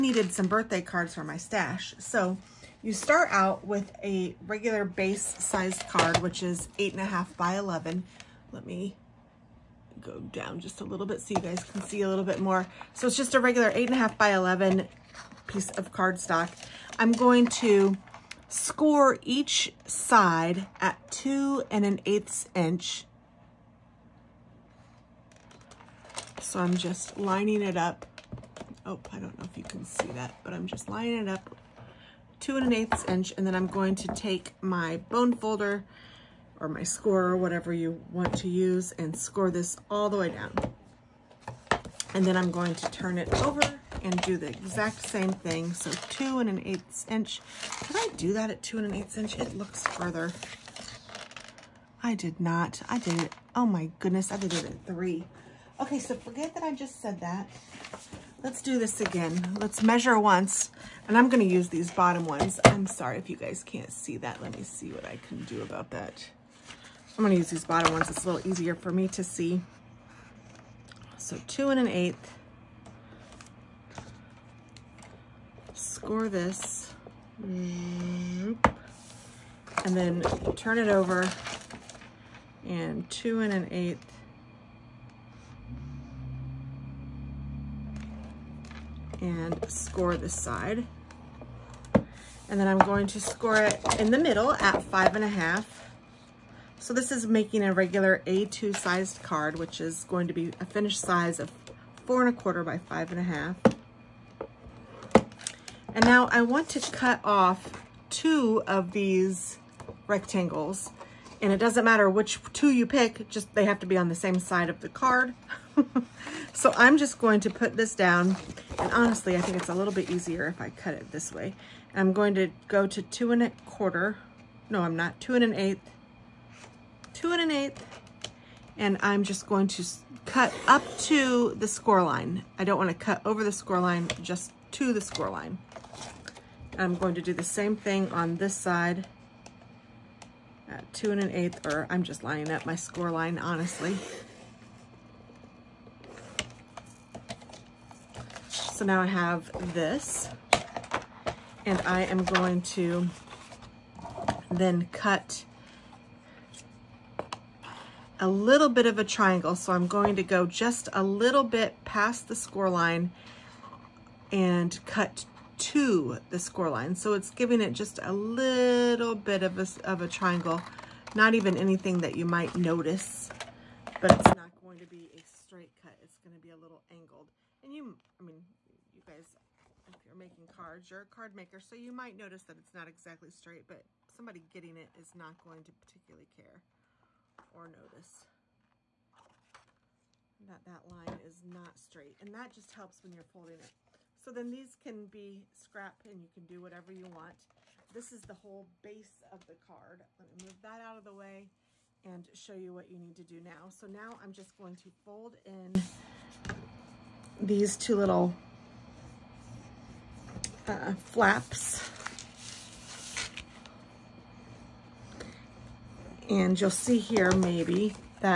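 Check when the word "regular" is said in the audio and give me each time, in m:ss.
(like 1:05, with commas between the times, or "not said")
0:04, 0:13, 1:37.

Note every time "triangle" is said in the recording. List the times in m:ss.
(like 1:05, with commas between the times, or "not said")
2:39, 2:50.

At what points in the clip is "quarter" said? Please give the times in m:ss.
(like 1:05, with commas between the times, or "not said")
1:42, 2:03.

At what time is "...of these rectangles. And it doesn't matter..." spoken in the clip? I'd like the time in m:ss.
1:48.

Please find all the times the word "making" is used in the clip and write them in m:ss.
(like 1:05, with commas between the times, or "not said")
1:37, 3:00.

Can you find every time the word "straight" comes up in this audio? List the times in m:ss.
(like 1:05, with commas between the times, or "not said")
2:55, 3:03, 3:11.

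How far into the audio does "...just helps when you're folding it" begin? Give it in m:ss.
3:12.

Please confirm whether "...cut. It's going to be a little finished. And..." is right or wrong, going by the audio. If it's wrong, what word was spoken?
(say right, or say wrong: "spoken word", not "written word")
wrong: "angled", not "finished".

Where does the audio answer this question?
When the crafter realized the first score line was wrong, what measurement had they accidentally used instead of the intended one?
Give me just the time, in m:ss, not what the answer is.
0:54.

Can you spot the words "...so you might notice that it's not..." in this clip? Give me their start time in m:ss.
3:01.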